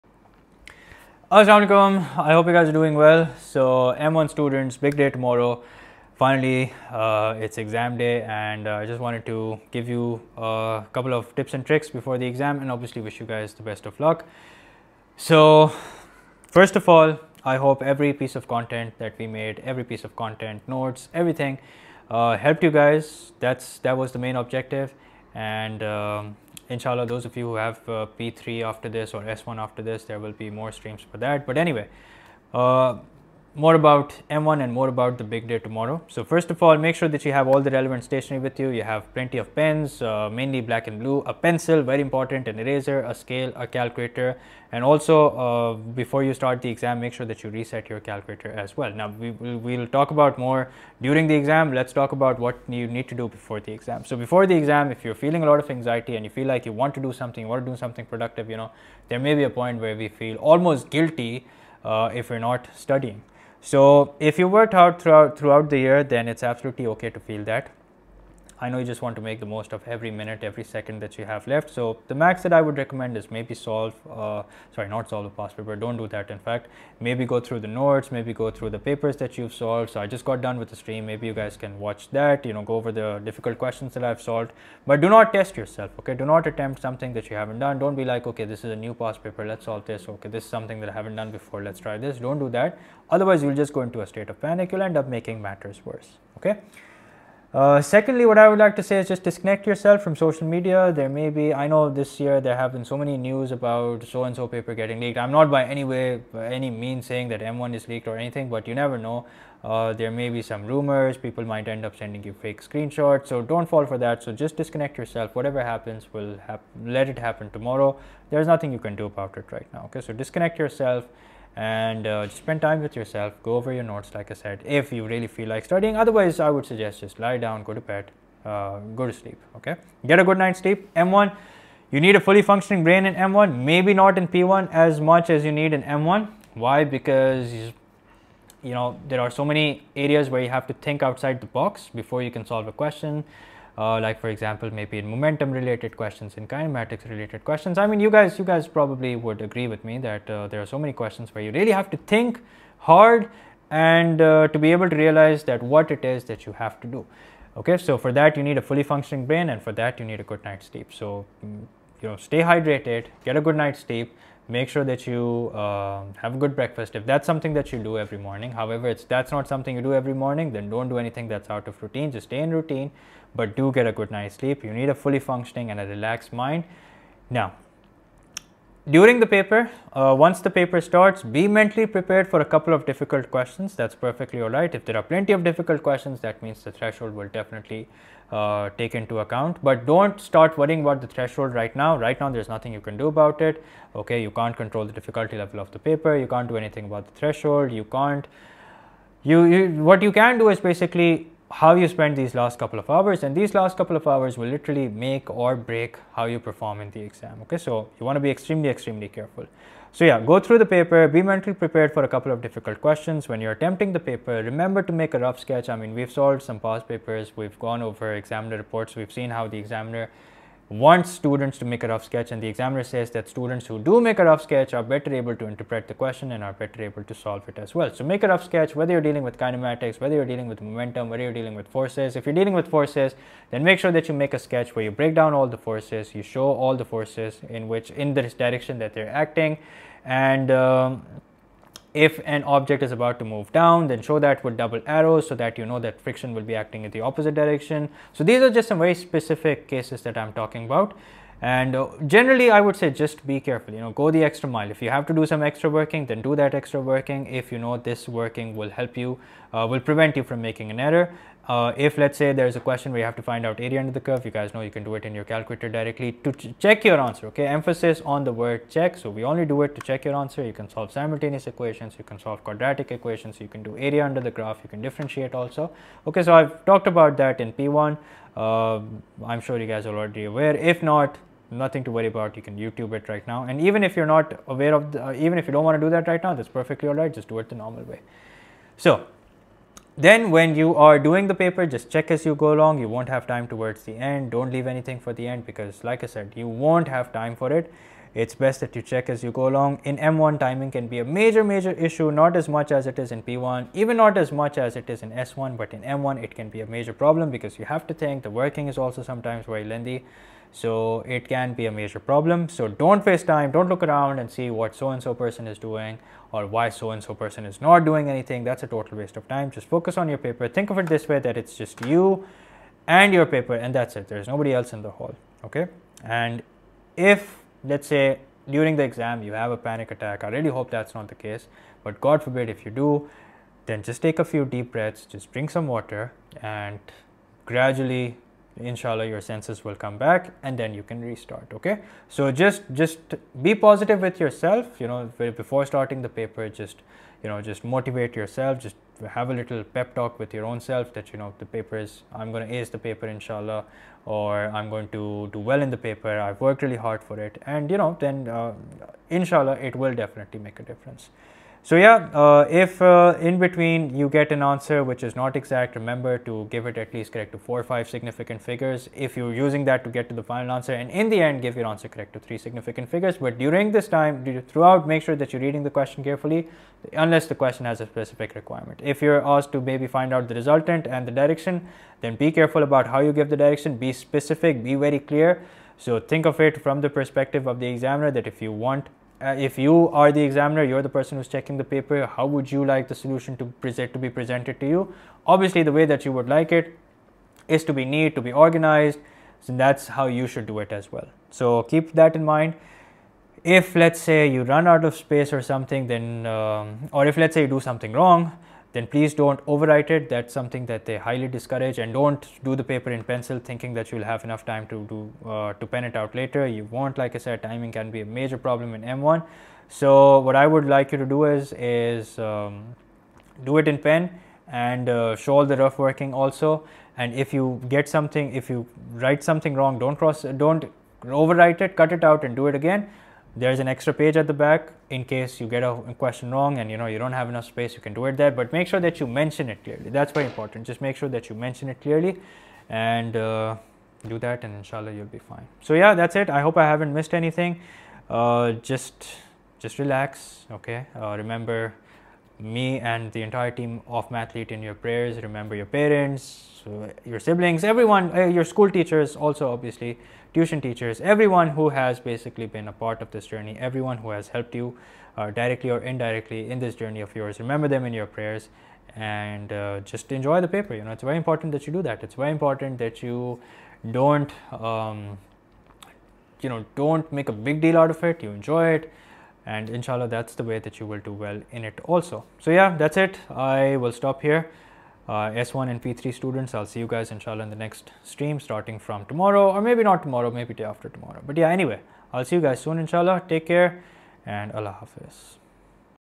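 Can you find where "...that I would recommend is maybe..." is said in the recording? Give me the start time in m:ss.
1:12.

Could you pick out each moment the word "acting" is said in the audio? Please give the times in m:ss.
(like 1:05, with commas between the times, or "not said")
3:59, 4:06.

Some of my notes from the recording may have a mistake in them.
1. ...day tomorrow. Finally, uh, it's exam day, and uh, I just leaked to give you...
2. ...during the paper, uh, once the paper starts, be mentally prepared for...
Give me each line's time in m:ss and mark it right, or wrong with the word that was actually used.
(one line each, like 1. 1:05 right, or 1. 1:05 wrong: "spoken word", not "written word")
1. 0:04 wrong: "wanted", not "leaked"
2. 2:58 right.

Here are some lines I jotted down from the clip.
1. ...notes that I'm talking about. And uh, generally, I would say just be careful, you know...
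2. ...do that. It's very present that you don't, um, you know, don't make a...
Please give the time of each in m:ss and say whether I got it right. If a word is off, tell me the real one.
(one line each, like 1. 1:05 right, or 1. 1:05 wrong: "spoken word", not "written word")
1. 4:09 wrong: "cases", not "notes"
2. 7:51 wrong: "important", not "present".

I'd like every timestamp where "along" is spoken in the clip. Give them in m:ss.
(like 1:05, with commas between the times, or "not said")
4:52, 4:59.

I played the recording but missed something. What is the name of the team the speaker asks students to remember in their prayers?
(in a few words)
Mathlete.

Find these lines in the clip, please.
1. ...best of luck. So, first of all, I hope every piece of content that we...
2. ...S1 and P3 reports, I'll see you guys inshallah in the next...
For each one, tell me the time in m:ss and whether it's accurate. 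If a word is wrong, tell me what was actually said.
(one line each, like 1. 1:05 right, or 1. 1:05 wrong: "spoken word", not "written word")
1. 0:13 right
2. 8:05 wrong: "students", not "reports".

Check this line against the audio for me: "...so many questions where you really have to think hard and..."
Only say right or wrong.
right.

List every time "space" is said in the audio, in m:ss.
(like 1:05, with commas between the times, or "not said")
6:44, 7:17.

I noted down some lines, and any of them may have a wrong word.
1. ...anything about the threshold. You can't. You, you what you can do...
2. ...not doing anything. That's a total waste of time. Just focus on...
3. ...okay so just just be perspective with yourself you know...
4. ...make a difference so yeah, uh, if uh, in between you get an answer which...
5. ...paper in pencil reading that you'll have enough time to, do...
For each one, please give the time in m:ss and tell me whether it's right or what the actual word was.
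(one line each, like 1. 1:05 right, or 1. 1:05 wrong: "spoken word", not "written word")
1. 3:16 right
2. 5:17 right
3. 5:41 wrong: "positive", not "perspective"
4. 6:00 right
5. 6:52 wrong: "thinking", not "reading".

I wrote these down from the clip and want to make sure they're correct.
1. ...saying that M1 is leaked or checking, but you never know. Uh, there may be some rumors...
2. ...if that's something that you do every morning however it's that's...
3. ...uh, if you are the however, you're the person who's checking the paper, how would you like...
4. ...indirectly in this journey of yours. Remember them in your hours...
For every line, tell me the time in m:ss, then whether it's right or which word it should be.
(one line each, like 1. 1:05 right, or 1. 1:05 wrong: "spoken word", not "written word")
1. 1:47 wrong: "anything", not "checking"
2. 2:46 right
3. 6:29 wrong: "examiner", not "however"
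4. 7:45 wrong: "prayers", not "hours".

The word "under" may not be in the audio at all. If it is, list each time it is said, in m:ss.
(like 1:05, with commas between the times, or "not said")
4:23, 4:34.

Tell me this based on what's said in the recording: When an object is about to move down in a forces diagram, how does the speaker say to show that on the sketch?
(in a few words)
Double arrows.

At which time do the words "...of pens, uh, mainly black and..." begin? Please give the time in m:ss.
0:39.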